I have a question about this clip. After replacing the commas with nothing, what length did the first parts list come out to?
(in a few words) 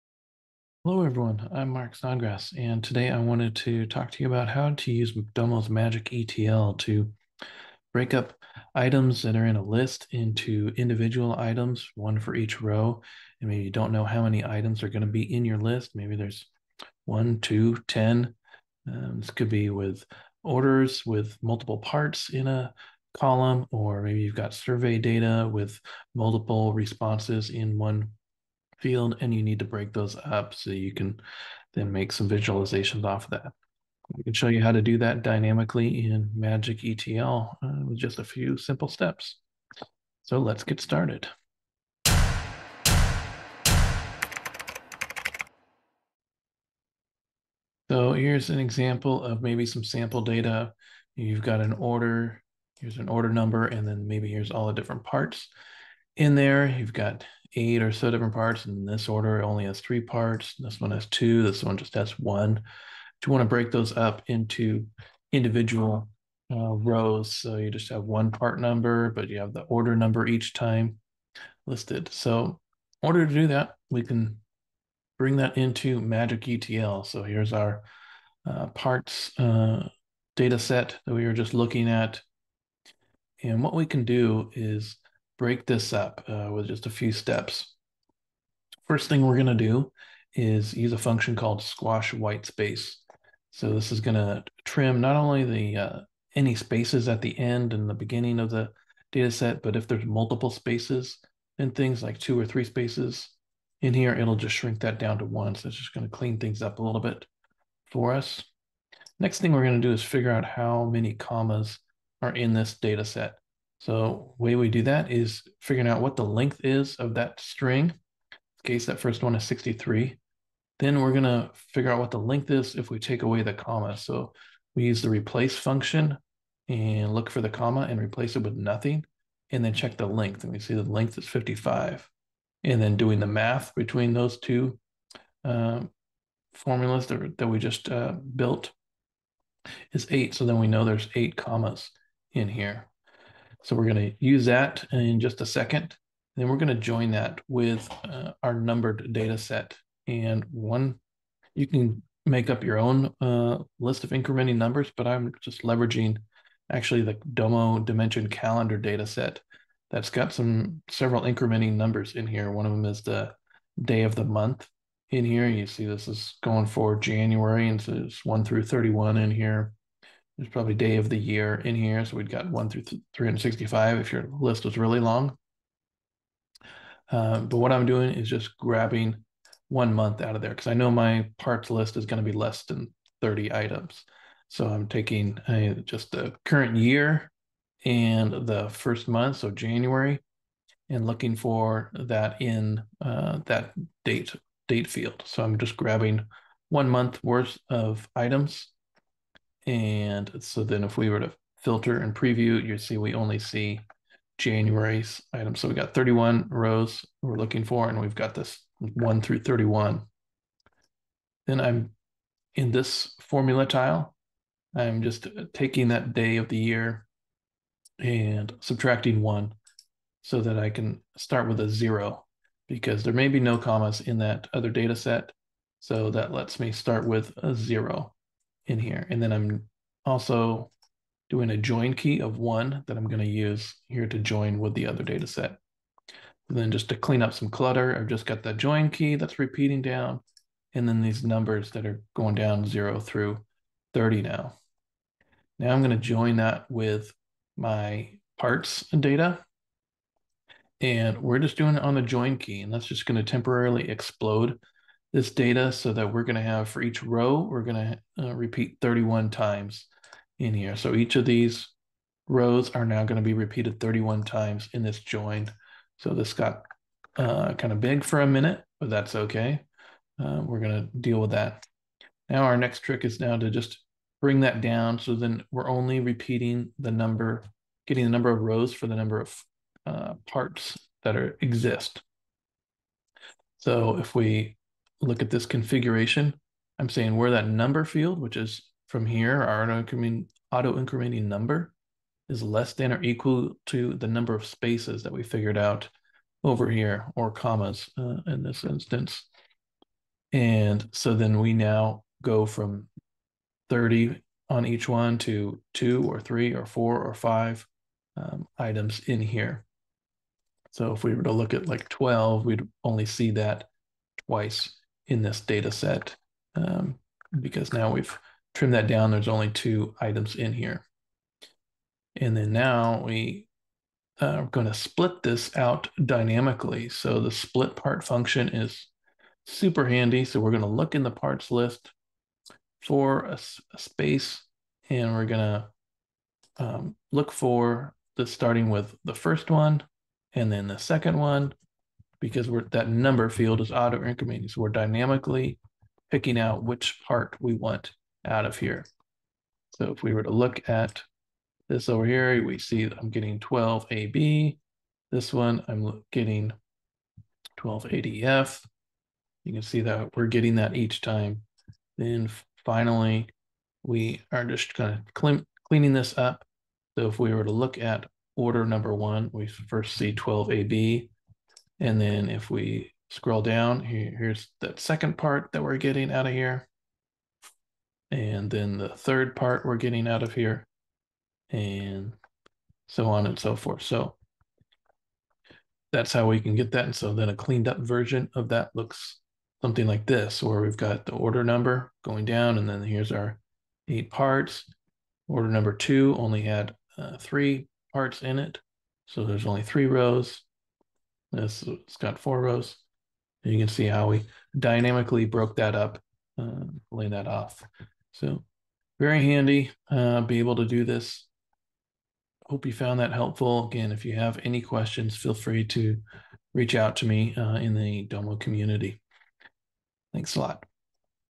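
55.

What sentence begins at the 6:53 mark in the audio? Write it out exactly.
Again, if you have any questions, feel free to reach out to me uh, in the Domo community.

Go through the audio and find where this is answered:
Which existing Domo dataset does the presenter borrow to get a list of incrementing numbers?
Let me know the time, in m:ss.
2:37.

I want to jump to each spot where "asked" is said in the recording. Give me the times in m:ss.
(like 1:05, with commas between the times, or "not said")
not said.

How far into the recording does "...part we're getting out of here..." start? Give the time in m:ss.
6:19.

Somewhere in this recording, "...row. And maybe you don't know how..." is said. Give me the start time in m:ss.
0:12.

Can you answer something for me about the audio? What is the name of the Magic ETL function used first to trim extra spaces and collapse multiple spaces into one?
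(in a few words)
squash white space.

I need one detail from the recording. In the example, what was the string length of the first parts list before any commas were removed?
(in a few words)
63.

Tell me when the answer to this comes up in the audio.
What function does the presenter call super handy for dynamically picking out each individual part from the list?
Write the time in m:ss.
5:27.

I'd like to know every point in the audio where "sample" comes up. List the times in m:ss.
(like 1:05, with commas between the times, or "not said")
0:49.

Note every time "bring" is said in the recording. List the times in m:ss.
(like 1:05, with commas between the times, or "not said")
1:15, 4:34.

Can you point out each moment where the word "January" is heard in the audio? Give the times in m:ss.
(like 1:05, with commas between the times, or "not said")
2:46, 3:09, 3:24.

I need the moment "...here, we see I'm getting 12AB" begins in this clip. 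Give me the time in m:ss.
5:52.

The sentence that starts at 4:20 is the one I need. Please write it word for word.
So each of these rows are now going to be repeated 31 times in this join.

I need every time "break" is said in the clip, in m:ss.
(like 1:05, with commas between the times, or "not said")
0:07, 0:29, 1:03, 1:25.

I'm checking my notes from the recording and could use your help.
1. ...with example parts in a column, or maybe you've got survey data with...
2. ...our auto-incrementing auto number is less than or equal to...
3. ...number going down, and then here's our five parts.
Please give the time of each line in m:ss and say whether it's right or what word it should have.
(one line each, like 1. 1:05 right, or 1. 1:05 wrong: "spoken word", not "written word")
1. 0:21 wrong: "multiple", not "example"
2. 4:49 right
3. 6:31 wrong: "eight", not "five".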